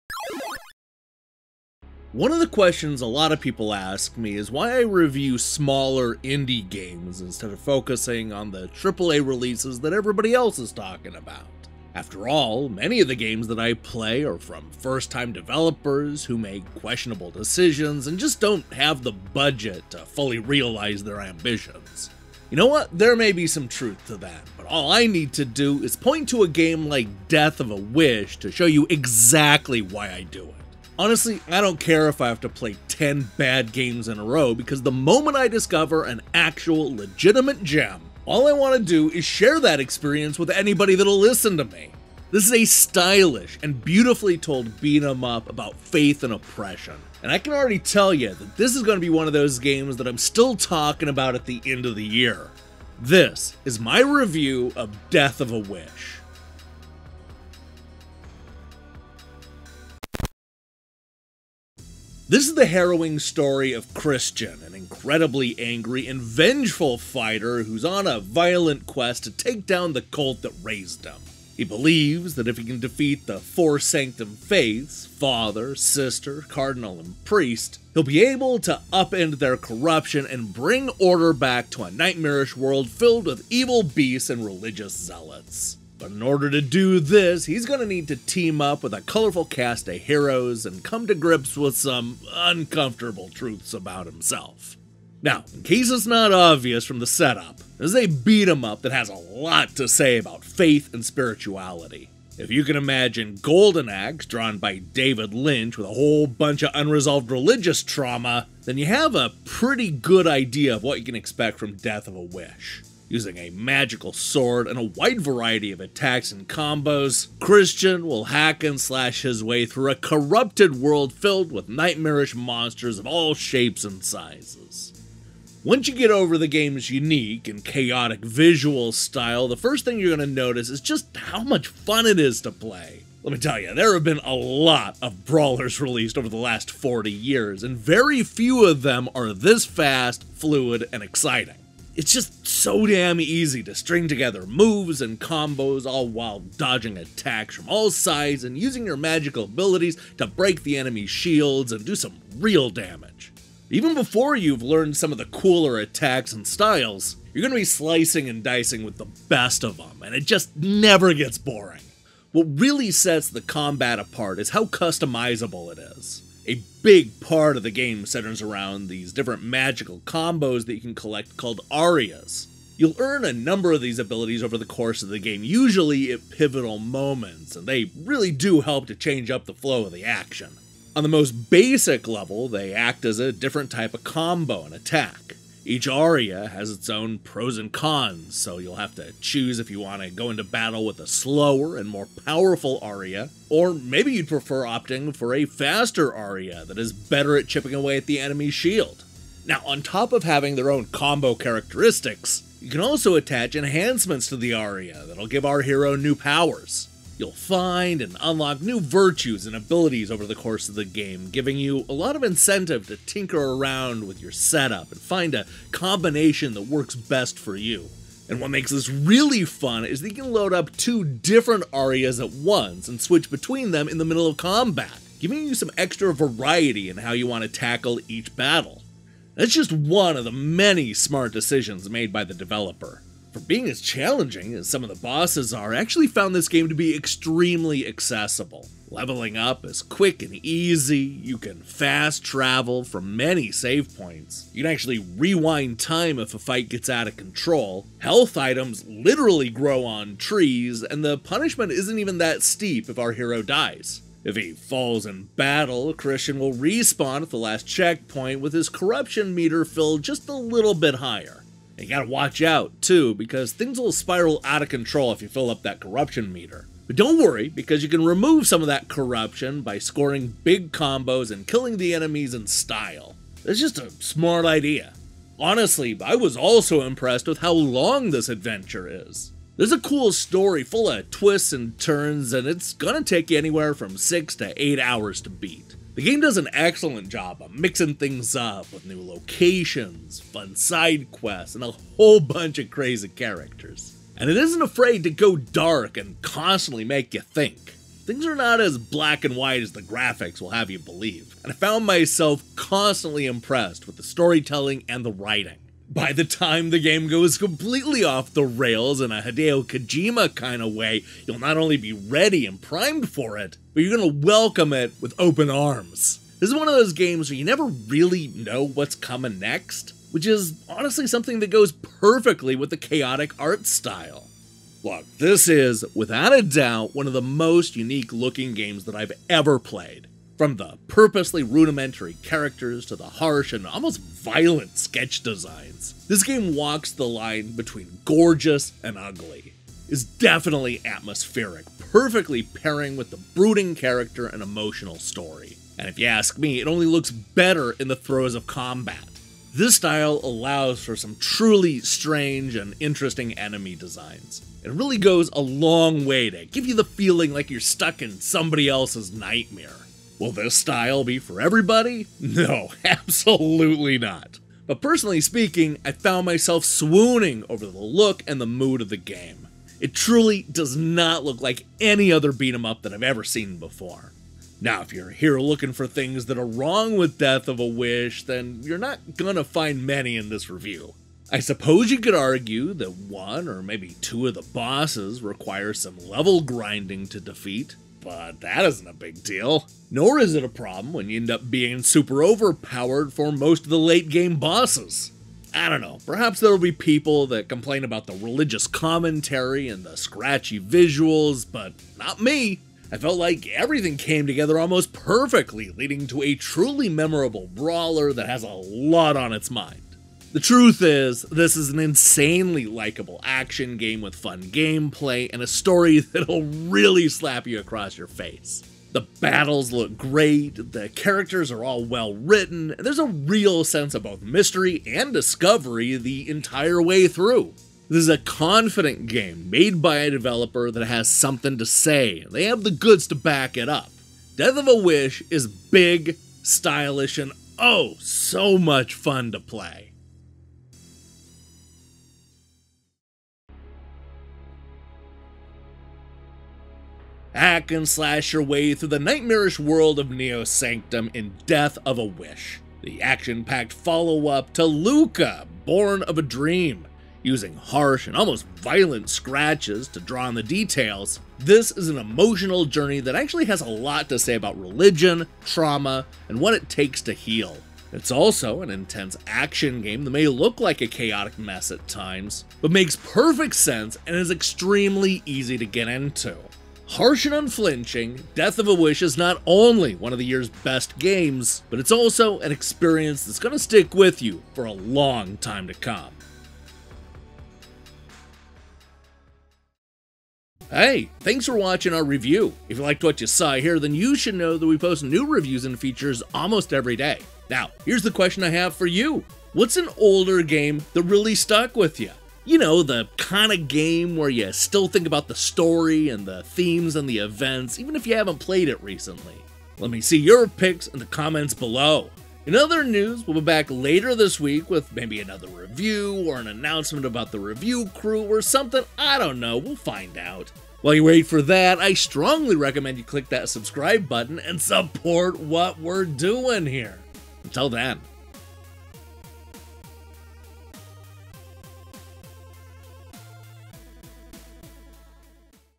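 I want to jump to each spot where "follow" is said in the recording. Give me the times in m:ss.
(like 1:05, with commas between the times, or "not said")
7:33.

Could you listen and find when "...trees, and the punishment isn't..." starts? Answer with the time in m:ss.
4:10.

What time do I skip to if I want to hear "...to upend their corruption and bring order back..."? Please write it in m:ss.
1:18.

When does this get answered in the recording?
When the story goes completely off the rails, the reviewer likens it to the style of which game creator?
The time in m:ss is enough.
5:09.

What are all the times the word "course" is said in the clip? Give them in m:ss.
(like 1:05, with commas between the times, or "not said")
2:54, 3:30.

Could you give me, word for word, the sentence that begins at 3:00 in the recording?
On the most basic level, they act as a different type of combo and attack.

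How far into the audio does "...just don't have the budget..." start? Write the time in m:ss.
0:18.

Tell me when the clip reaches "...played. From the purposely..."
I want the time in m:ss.
5:29.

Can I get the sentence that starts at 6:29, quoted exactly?
Nor is it a problem when you end up being super overpowered for most of the late game bosses.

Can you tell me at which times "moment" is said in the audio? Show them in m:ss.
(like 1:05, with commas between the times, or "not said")
0:34, 2:56.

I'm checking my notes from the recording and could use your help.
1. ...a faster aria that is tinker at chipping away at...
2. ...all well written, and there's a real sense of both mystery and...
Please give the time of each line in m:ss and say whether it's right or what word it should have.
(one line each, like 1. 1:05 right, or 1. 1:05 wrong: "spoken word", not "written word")
1. 3:15 wrong: "better", not "tinker"
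2. 7:01 right.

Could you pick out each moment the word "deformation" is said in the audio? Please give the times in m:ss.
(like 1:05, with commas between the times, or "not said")
not said.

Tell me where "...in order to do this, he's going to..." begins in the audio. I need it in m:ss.
1:26.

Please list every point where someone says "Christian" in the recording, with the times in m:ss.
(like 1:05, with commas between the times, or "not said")
1:03, 1:57, 4:15.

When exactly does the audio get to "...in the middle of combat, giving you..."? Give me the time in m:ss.
3:43.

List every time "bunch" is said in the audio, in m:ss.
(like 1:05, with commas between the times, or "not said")
1:46, 4:52.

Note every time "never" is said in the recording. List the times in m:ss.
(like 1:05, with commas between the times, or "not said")
2:40, 5:17.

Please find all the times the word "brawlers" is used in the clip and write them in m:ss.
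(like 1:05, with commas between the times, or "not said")
2:15, 6:47.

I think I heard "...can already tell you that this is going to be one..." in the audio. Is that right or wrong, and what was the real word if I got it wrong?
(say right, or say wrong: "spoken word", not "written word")
right.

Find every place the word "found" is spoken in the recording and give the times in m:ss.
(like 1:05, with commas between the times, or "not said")
3:56, 5:01, 6:05.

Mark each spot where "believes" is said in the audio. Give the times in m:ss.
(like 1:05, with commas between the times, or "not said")
1:11, 5:00.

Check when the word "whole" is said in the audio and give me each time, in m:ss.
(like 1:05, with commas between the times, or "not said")
1:45, 4:51.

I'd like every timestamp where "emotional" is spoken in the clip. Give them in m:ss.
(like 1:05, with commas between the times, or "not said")
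5:44, 7:41.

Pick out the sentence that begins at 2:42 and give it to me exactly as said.
What really sets the combat apart is how customizable it is.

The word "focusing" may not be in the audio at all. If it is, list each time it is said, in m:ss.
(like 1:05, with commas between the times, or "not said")
0:07.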